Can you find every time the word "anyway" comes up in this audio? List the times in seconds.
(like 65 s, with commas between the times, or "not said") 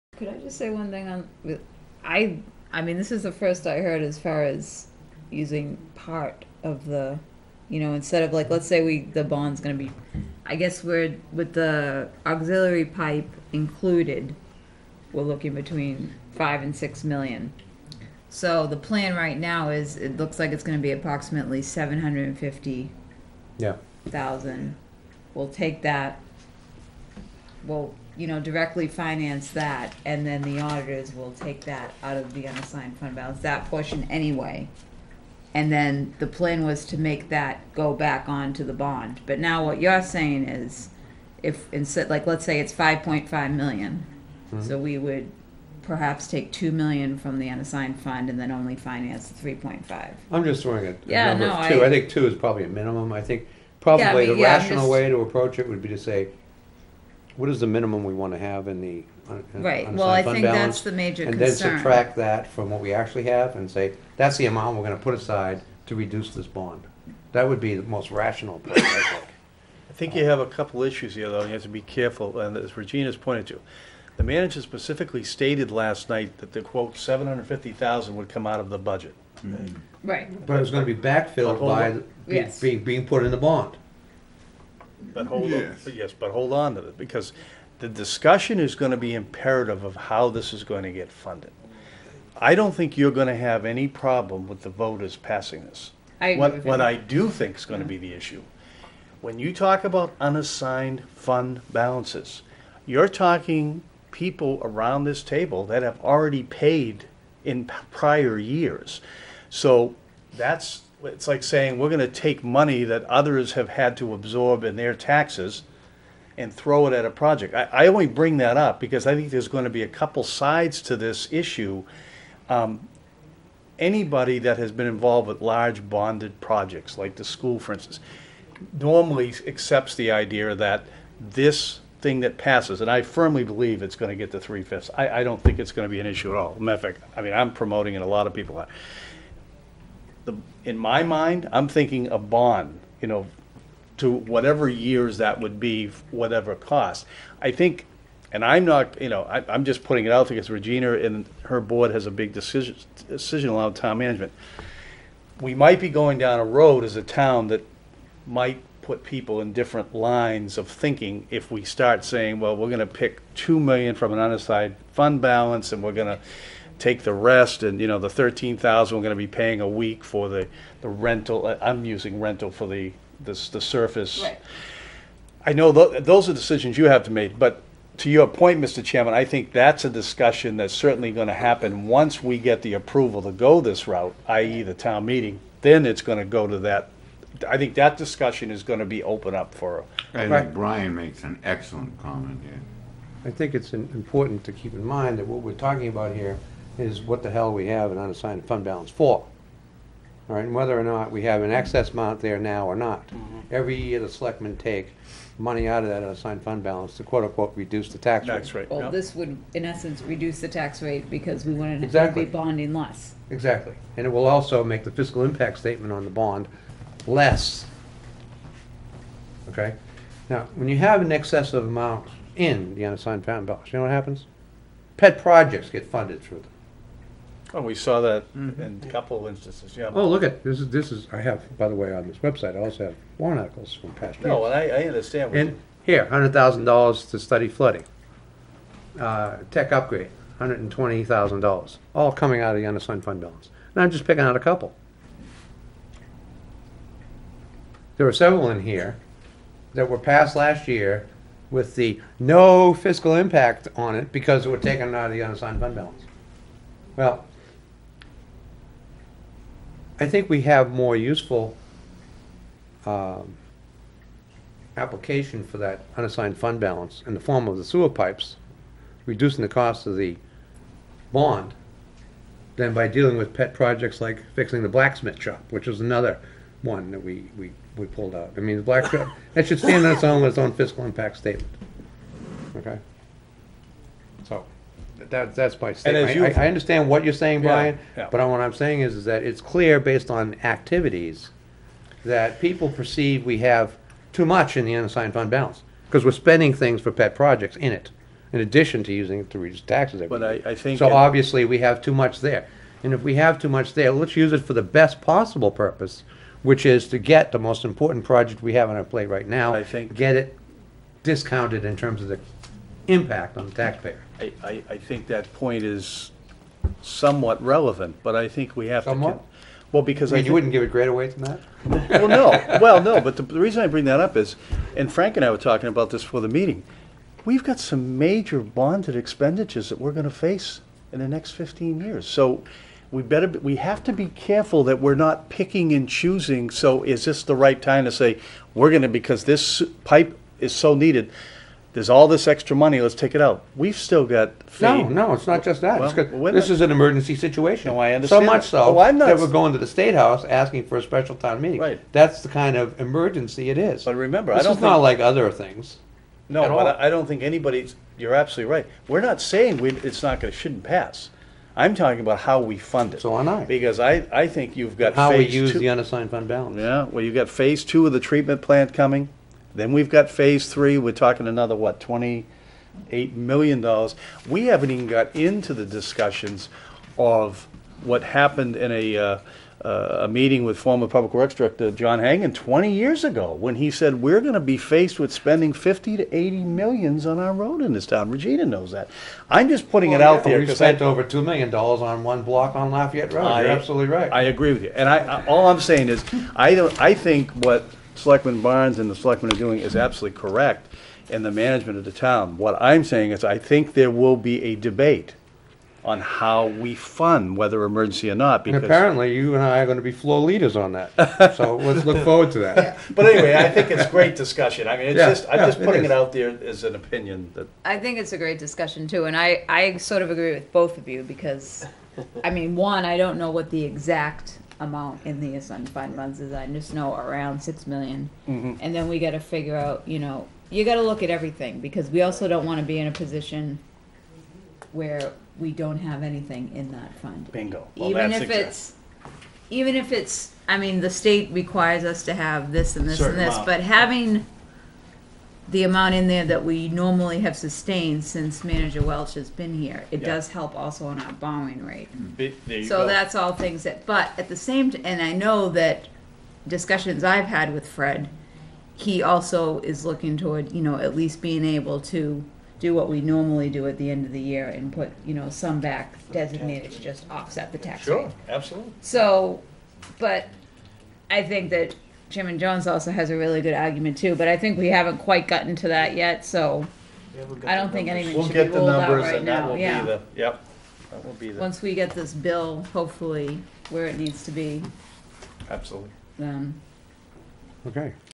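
34 s, 413 s.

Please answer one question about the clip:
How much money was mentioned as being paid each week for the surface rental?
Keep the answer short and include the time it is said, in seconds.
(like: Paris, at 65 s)
$13,000, at 168 s.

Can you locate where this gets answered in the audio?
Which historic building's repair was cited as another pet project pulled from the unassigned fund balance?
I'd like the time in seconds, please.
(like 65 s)
274 s.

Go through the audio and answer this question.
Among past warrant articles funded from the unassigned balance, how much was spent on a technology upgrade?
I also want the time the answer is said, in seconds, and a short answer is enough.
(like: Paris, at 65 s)
$120,000, at 240 s.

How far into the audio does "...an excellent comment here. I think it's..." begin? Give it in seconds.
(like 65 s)
191 s.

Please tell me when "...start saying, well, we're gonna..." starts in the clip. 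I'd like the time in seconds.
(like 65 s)
161 s.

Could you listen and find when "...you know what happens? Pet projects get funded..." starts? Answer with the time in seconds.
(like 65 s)
223 s.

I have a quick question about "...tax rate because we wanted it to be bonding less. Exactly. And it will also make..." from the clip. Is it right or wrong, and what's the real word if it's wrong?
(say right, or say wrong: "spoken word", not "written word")
right.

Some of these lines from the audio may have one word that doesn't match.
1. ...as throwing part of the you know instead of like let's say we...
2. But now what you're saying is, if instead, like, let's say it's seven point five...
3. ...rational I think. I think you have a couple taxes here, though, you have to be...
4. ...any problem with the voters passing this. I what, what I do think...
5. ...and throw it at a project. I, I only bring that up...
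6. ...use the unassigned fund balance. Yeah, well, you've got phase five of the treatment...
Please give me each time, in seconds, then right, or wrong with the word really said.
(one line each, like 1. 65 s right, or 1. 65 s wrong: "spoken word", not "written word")
1. 4 s wrong: "using", not "throwing"
2. 39 s wrong: "five", not "seven"
3. 68 s wrong: "issues", not "taxes"
4. 93 s right
5. 116 s right
6. 365 s wrong: "two", not "five".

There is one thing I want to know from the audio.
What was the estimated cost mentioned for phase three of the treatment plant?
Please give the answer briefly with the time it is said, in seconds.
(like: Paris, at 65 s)
$28 million, at 371 s.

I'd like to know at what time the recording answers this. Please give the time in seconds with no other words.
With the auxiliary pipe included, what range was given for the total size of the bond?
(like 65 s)
15 s.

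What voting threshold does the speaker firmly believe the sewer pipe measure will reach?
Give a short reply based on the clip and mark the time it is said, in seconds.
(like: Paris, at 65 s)
three fifths, at 134 s.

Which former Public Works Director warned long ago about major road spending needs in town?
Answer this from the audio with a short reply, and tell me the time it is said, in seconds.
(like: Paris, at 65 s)
John Hagan, at 381 s.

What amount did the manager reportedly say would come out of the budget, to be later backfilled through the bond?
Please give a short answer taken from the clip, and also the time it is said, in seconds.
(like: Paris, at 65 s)
$750,000, at 76 s.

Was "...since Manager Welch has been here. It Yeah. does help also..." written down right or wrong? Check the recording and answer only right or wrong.
right.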